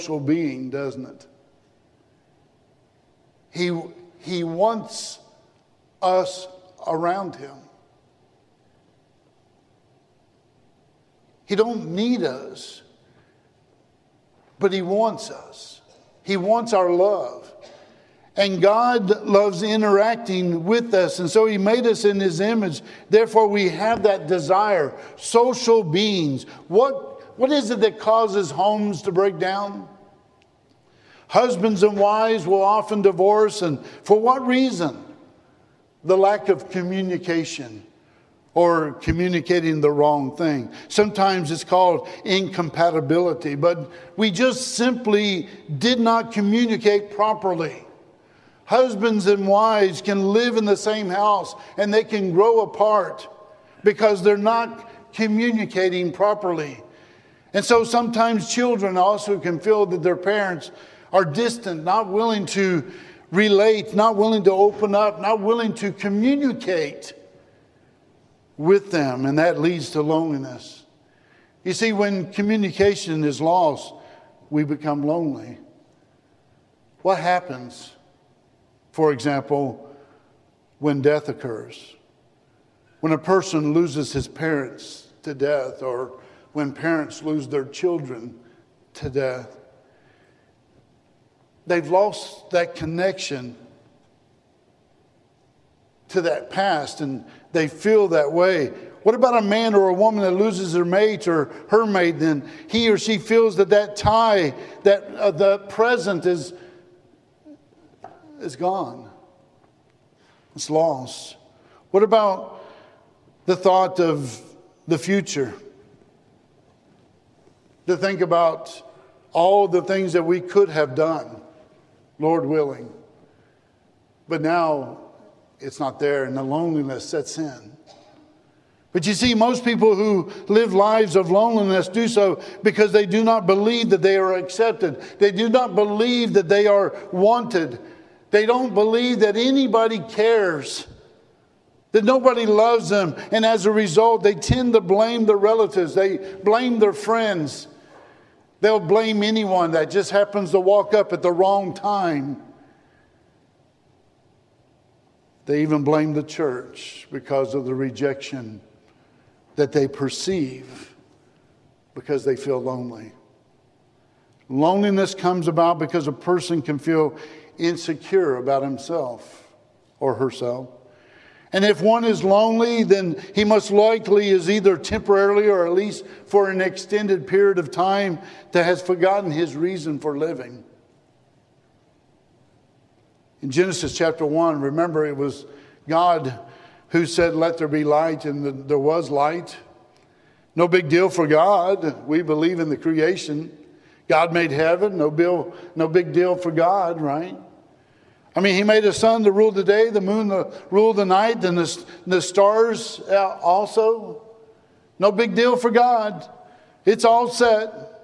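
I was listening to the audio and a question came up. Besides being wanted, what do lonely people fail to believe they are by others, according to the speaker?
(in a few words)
accepted.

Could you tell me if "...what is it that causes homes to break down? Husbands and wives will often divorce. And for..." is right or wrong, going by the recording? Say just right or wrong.
right.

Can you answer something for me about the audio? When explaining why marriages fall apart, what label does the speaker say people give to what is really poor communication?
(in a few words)
incompatibility.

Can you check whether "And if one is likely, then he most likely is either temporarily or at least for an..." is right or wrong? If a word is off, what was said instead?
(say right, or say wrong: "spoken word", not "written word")
wrong: "lonely", not "likely".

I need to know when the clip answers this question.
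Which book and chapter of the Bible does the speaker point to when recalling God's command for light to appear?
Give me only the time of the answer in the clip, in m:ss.
3:03.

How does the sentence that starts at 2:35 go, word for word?
They even blame the church because of the rejection that they perceive because they feel lonely.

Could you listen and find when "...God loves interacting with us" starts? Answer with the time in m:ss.
0:18.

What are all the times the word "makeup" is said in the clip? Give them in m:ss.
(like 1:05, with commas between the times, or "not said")
not said.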